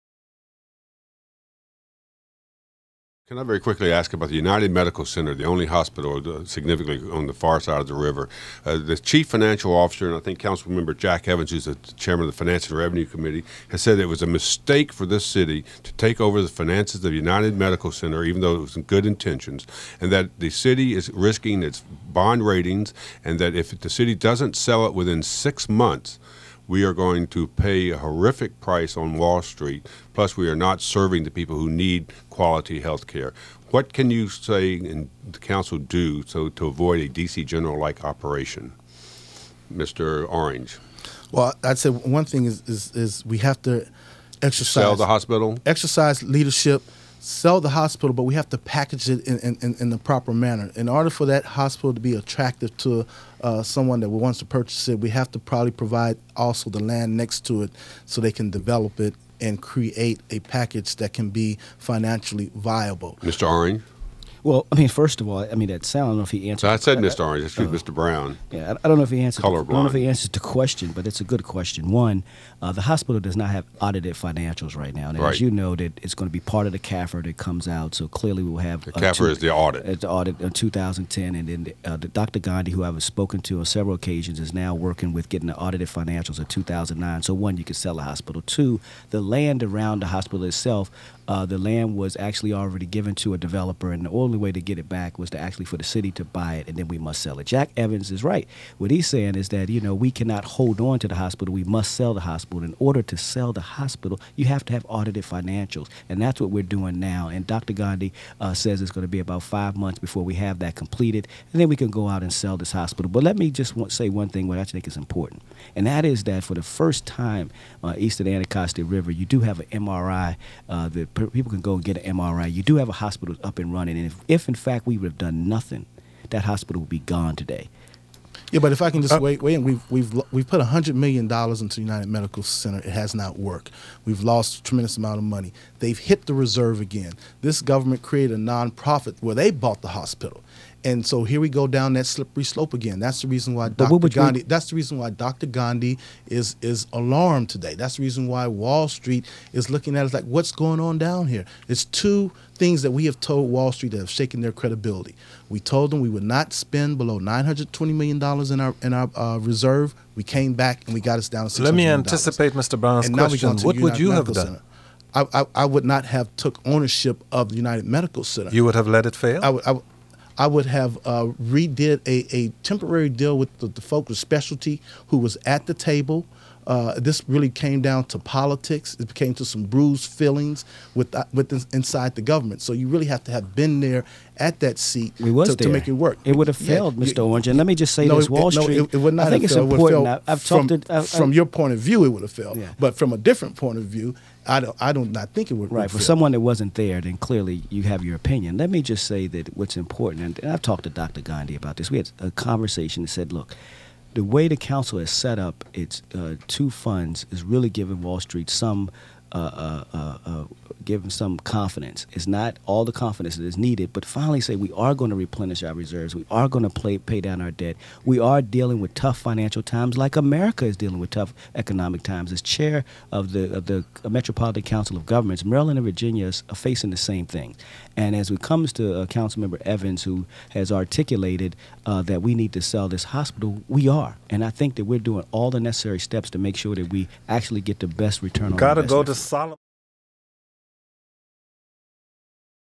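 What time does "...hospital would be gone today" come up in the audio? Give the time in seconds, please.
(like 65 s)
126 s.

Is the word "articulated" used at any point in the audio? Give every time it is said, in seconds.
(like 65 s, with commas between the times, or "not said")
230 s.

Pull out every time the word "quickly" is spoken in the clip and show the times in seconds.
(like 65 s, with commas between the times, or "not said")
3 s.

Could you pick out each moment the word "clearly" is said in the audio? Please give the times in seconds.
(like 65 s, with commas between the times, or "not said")
78 s, 197 s.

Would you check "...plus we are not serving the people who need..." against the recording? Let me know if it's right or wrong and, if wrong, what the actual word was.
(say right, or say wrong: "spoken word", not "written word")
right.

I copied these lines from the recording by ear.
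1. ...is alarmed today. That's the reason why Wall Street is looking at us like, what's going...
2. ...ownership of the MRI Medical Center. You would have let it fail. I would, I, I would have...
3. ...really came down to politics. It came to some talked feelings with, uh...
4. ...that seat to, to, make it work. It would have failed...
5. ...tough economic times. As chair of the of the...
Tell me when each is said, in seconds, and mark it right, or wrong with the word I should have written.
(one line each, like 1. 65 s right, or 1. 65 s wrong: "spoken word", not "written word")
1. 146 s right
2. 166 s wrong: "United", not "MRI"
3. 177 s wrong: "bruised", not "talked"
4. 184 s right
5. 221 s right.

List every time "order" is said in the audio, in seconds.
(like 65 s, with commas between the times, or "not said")
50 s, 102 s.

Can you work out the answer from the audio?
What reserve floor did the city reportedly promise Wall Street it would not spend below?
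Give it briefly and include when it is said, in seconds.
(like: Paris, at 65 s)
$920 million, at 157 s.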